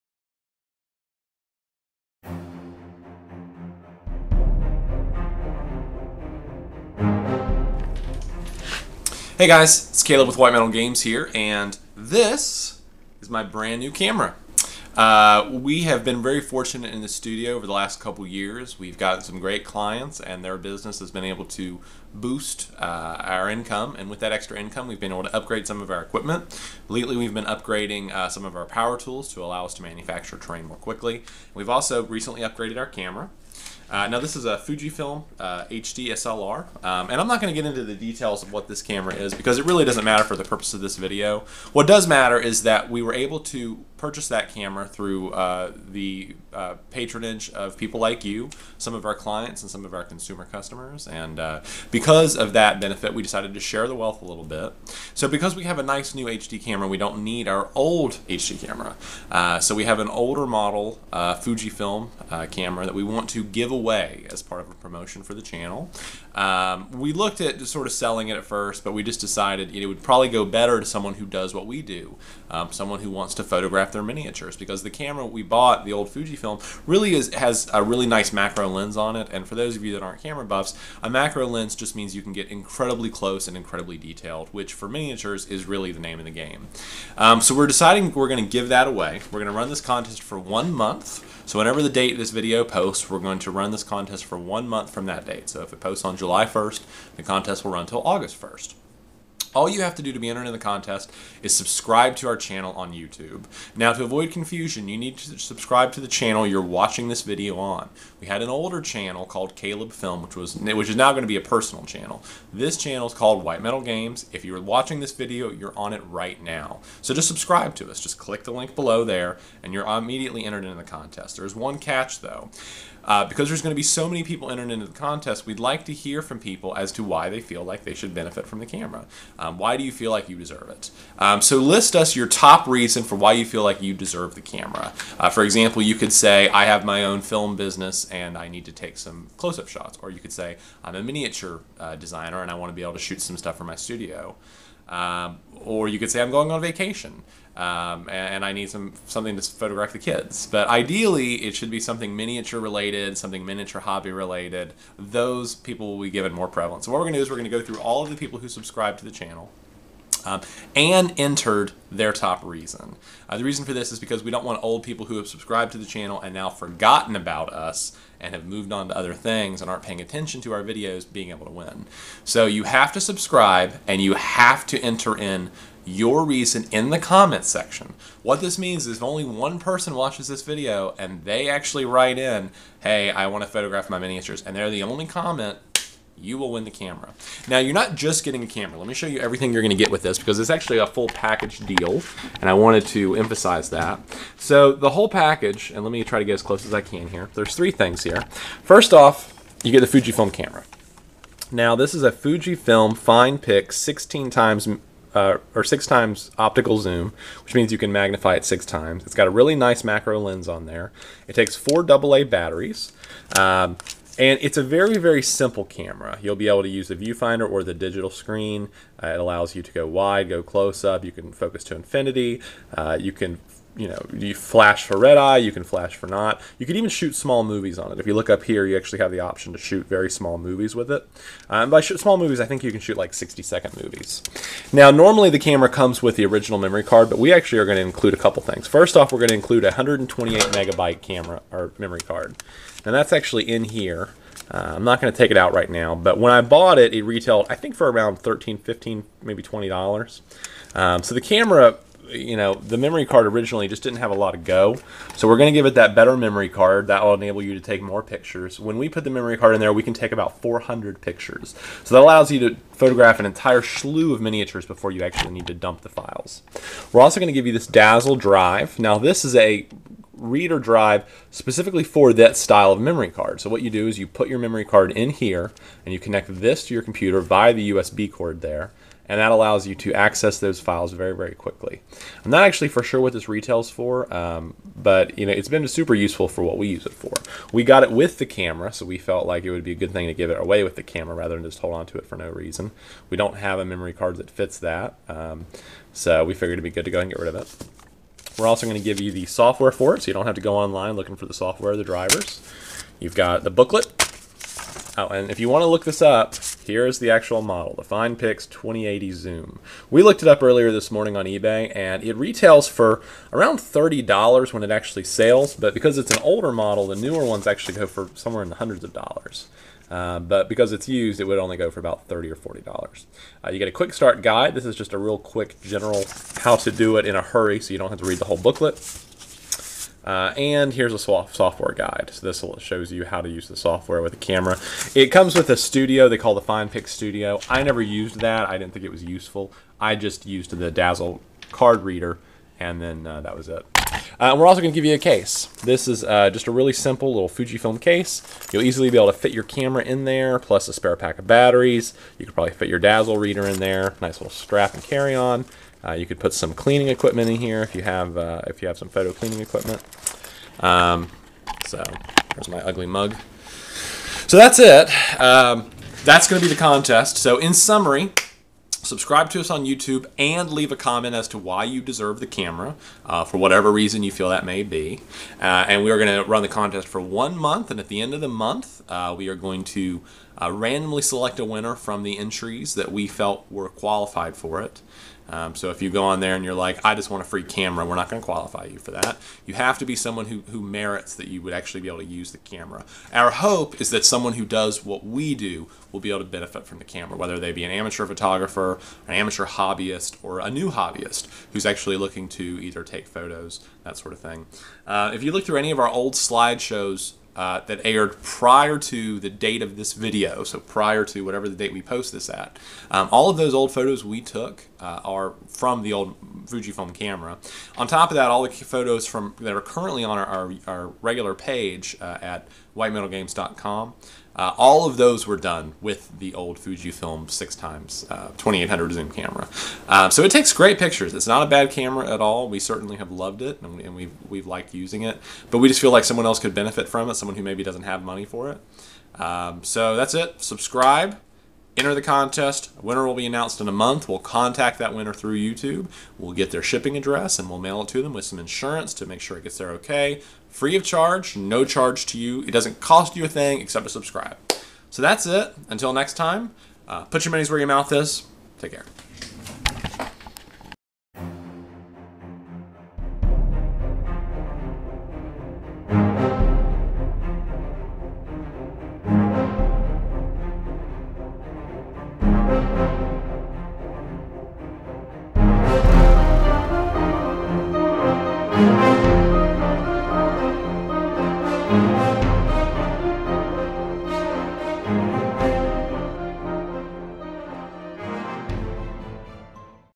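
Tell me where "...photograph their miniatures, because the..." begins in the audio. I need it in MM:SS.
01:13.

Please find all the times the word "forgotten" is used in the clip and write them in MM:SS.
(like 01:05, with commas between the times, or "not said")
02:46.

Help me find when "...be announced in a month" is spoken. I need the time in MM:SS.
07:23.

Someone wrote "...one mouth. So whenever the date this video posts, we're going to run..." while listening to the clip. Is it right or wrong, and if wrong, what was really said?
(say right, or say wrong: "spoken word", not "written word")
wrong: "month", not "mouth".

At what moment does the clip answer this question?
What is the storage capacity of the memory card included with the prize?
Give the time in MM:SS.
03:59.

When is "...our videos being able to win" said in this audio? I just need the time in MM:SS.
02:50.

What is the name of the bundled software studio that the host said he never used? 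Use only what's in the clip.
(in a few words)
FinePix Studio.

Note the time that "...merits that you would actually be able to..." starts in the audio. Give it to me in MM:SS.
06:30.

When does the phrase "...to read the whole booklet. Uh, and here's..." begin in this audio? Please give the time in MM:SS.
05:27.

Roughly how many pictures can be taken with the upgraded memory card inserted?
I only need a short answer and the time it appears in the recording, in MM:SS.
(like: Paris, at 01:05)
400, at 04:20.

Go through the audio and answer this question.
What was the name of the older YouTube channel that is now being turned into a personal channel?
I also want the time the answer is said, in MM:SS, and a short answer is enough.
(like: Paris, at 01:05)
Caleb Film, at 01:49.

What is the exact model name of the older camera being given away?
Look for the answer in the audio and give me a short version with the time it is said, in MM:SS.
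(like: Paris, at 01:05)
FinePix 2080 Zoom, at 05:07.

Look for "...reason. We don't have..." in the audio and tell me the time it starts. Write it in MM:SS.
04:52.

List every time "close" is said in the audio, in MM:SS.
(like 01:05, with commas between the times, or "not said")
01:23, 02:19, 03:16, 03:40.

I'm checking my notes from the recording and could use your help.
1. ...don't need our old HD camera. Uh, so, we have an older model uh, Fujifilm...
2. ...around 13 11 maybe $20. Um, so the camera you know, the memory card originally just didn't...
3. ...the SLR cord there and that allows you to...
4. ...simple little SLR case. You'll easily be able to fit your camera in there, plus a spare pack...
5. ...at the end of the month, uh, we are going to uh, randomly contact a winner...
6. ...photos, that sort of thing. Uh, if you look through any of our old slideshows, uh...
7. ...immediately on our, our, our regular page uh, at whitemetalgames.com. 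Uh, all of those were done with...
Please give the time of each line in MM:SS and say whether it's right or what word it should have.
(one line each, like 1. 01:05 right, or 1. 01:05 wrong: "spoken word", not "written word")
1. 00:56 right
2. 04:07 wrong: "15", not "11"
3. 04:37 wrong: "USB", not "SLR"
4. 05:46 wrong: "Fujifilm", not "SLR"
5. 06:17 wrong: "select", not "contact"
6. 06:43 right
7. 06:59 wrong: "currently", not "immediately".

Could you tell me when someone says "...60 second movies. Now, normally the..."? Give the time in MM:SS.
03:53.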